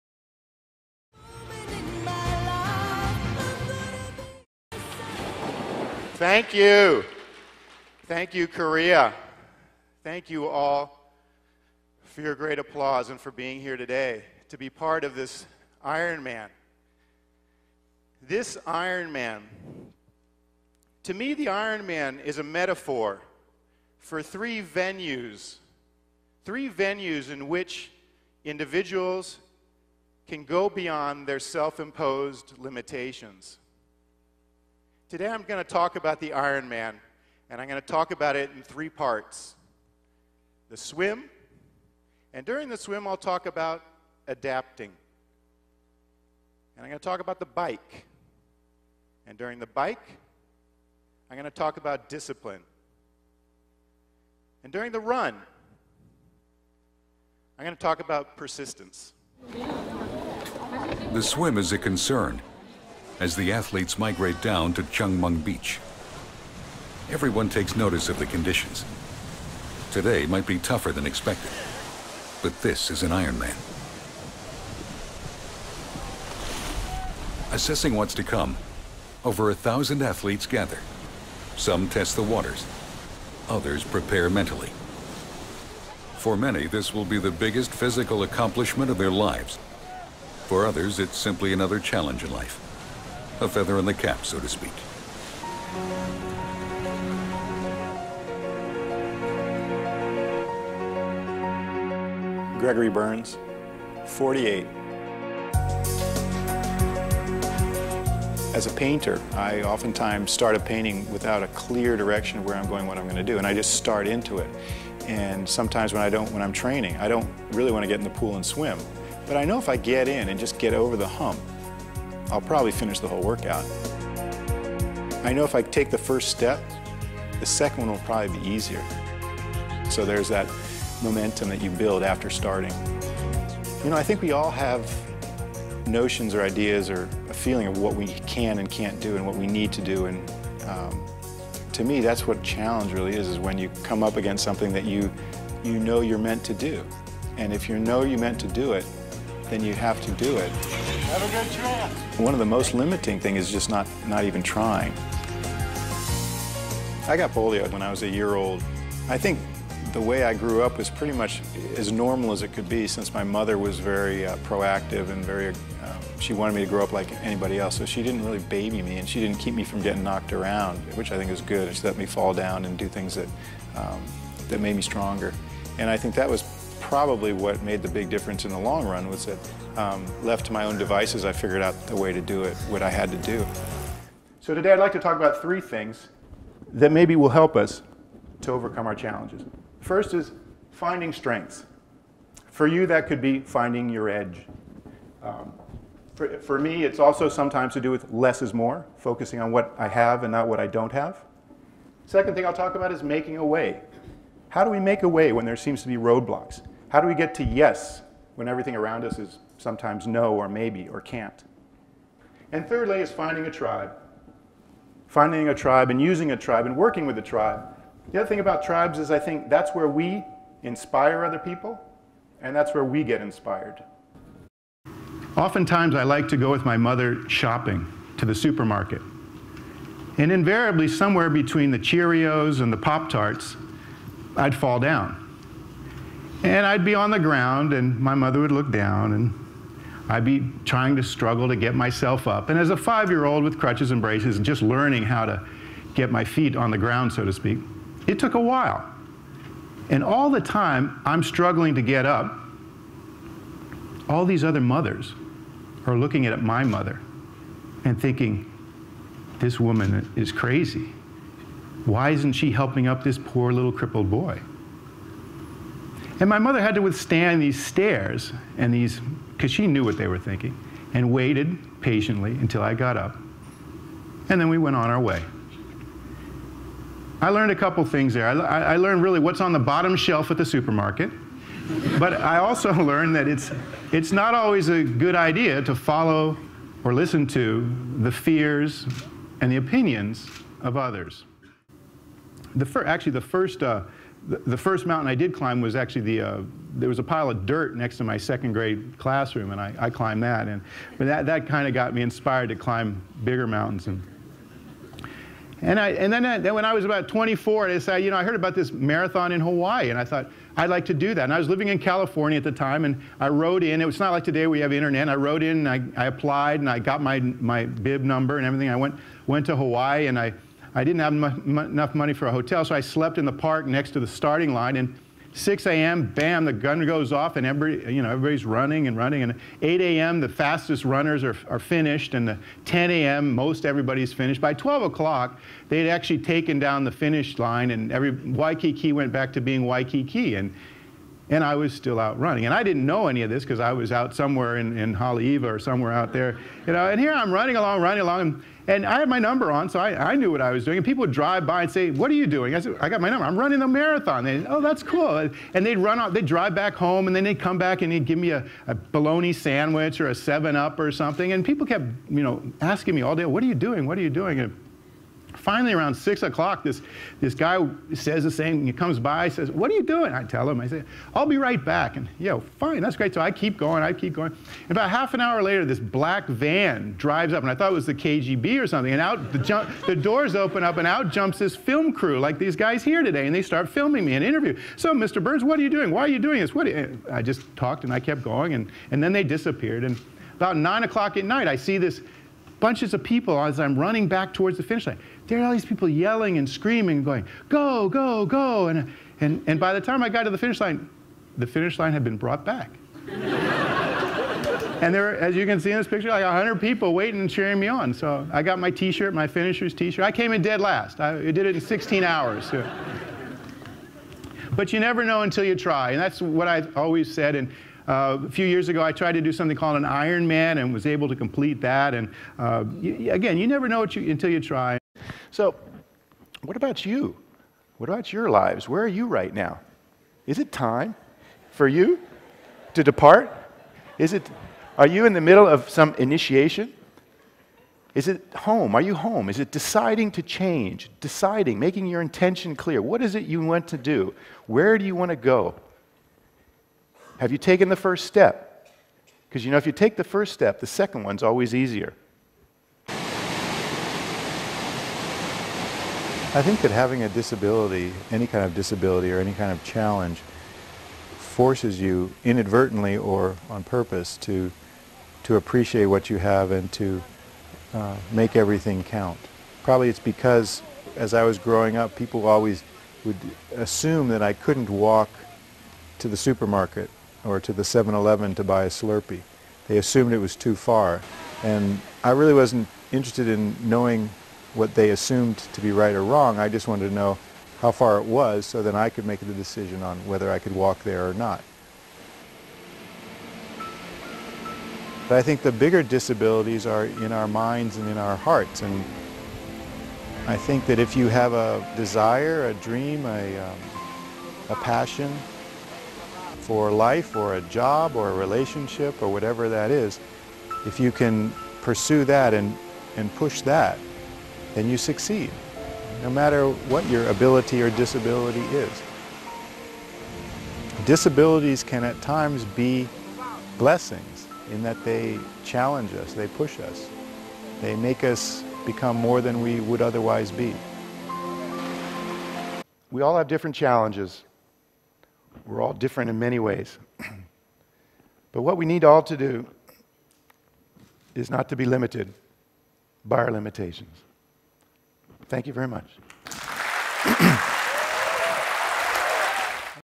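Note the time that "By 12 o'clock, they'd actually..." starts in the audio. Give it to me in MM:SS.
05:34.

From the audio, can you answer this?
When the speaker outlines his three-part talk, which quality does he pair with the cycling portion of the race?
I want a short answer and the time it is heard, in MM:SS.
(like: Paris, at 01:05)
Discipline, at 00:52.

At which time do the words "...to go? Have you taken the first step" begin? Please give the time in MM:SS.
07:25.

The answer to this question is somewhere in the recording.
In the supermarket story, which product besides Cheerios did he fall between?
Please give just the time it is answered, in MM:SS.
03:52.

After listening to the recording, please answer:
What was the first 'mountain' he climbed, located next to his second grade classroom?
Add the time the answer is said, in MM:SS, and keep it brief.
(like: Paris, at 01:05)
A pile of dirt, at 04:57.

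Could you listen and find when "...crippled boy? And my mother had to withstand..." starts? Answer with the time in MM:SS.
04:23.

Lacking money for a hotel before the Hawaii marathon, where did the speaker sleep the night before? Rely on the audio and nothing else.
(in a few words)
In the park.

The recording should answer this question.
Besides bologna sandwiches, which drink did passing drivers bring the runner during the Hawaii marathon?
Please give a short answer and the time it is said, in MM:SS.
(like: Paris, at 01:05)
7-Up, at 06:00.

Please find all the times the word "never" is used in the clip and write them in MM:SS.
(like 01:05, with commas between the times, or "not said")
06:54, 07:03.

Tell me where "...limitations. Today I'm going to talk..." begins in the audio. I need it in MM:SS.
00:32.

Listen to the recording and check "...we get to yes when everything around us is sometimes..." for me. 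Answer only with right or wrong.
right.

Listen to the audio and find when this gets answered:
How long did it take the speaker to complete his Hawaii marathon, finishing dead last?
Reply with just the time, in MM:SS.
06:51.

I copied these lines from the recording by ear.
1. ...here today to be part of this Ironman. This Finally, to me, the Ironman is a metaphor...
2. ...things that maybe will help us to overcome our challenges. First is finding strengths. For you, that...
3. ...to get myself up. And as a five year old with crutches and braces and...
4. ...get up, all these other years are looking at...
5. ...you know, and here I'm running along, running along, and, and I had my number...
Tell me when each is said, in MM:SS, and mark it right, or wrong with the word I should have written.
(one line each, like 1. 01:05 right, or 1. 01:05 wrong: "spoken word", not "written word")
1. 00:13 wrong: "Ironman", not "Finally"
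2. 03:05 right
3. 04:01 right
4. 04:11 wrong: "mothers", not "years"
5. 05:46 right.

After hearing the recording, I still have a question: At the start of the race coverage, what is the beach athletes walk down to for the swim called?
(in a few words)
Jungmun Beach.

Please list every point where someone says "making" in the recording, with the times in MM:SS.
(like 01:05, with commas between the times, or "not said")
03:23, 07:21.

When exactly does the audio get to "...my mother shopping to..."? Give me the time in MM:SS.
03:46.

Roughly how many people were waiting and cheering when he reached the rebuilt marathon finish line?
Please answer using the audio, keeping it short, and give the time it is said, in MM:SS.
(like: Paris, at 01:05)
100, at 06:46.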